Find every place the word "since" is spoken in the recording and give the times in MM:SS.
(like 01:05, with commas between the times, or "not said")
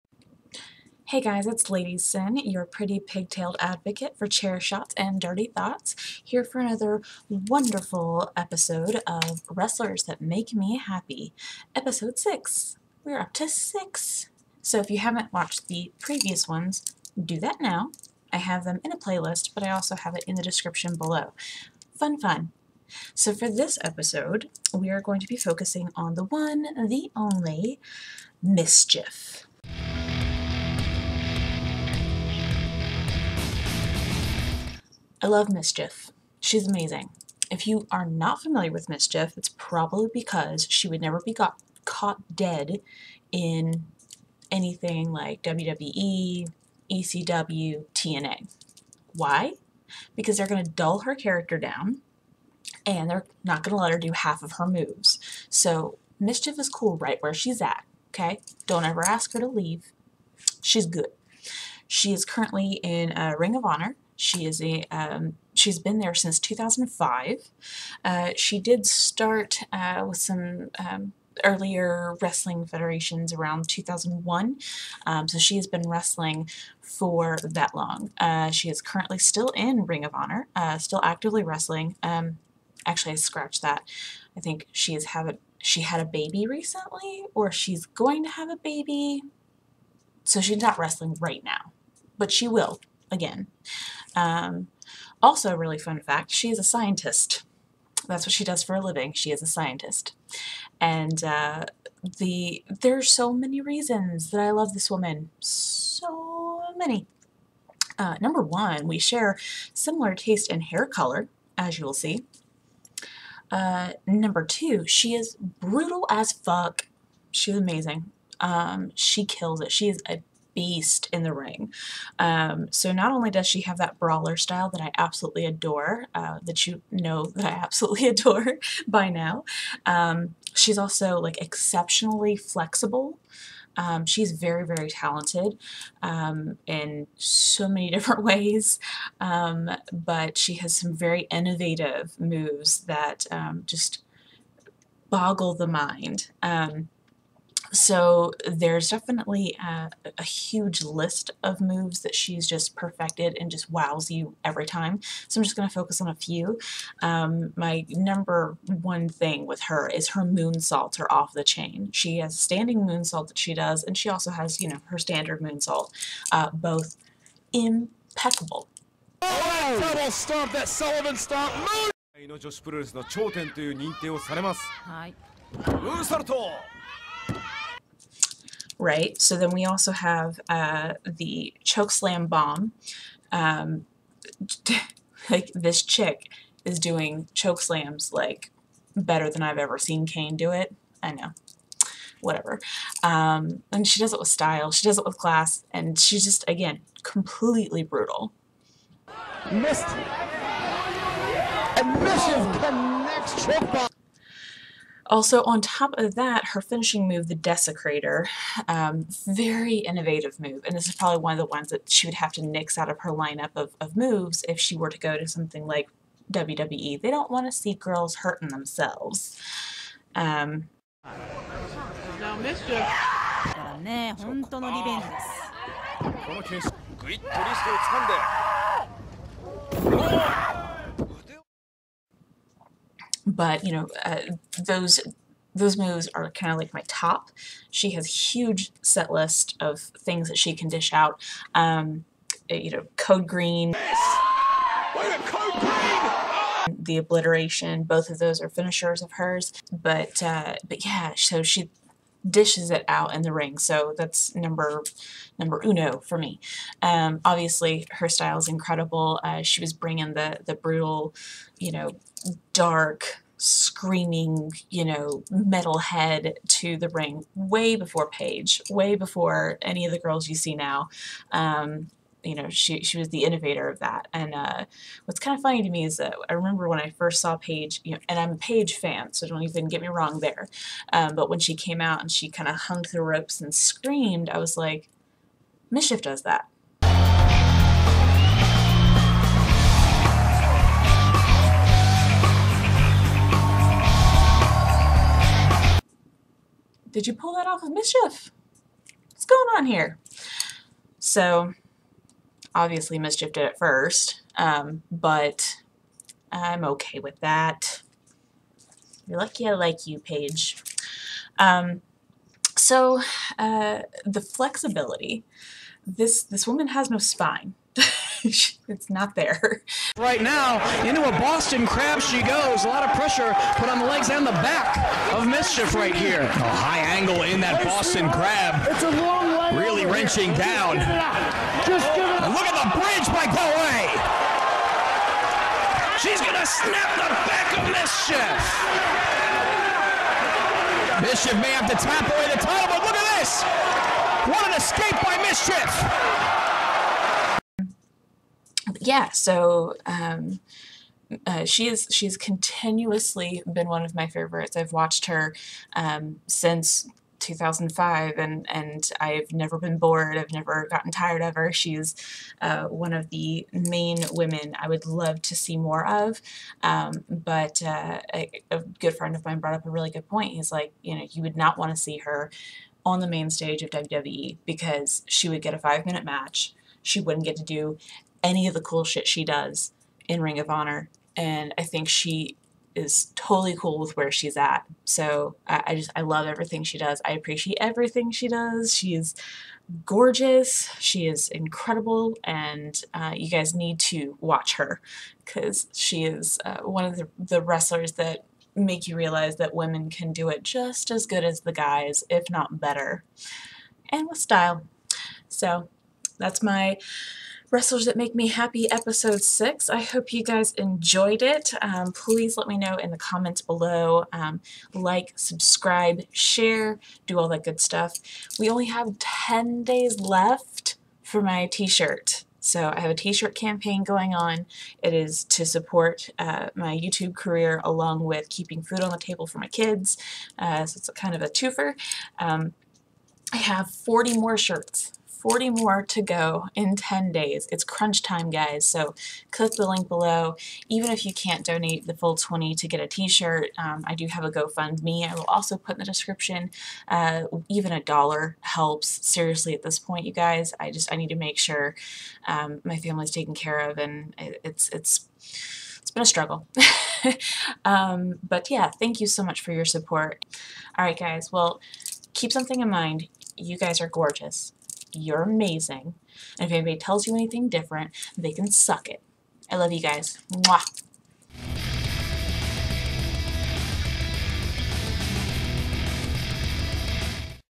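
01:06, 05:56.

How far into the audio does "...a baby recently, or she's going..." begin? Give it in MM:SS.
01:25.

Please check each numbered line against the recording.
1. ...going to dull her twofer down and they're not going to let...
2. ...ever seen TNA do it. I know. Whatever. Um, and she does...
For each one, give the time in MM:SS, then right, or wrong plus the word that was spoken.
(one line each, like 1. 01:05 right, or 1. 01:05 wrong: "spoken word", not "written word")
1. 00:50 wrong: "character", not "twofer"
2. 03:09 wrong: "Kane", not "TNA".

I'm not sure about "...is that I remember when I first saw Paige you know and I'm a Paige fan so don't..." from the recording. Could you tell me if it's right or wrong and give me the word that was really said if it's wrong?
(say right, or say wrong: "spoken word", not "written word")
right.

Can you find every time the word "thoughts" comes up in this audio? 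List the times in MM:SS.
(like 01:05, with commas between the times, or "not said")
00:05.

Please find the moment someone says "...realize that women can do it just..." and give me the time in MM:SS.
06:38.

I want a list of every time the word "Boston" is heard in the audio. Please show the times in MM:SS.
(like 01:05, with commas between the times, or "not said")
05:21, 05:27.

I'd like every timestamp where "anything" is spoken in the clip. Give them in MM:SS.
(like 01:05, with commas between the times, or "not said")
00:44, 07:47.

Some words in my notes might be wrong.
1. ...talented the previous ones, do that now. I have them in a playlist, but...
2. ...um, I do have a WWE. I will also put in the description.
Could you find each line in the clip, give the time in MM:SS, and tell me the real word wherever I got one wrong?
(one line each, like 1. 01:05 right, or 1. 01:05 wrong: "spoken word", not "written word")
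1. 00:15 wrong: "watched", not "talented"
2. 07:23 wrong: "GoFundMe", not "WWE".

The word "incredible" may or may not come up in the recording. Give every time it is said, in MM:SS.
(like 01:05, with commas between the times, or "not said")
04:18, 06:31.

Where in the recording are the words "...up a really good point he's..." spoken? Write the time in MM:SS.
06:09.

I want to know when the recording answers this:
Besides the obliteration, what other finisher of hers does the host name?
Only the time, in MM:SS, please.
04:02.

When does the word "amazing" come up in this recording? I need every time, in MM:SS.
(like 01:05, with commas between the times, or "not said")
00:36, 01:57, 07:45.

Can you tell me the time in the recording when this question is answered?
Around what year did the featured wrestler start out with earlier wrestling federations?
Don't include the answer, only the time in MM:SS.
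01:13.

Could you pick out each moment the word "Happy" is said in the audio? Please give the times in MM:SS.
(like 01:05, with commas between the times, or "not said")
00:10, 06:48.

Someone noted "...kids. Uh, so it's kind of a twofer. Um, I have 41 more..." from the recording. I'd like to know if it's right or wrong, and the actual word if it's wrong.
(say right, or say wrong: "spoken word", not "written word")
wrong: "40", not "41".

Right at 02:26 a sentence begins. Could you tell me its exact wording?
Um, so there's definitely a, a, huge list of moves that she's just perfected and just wows you every time.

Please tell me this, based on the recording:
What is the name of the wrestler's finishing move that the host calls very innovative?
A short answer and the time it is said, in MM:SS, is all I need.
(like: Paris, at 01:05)
the Desecrator, at 03:27.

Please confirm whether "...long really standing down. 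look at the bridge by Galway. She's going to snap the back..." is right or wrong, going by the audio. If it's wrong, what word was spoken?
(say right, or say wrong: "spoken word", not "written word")
wrong: "wrenching", not "standing".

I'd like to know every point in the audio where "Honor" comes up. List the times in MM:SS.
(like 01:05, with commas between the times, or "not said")
01:03, 01:20, 06:20.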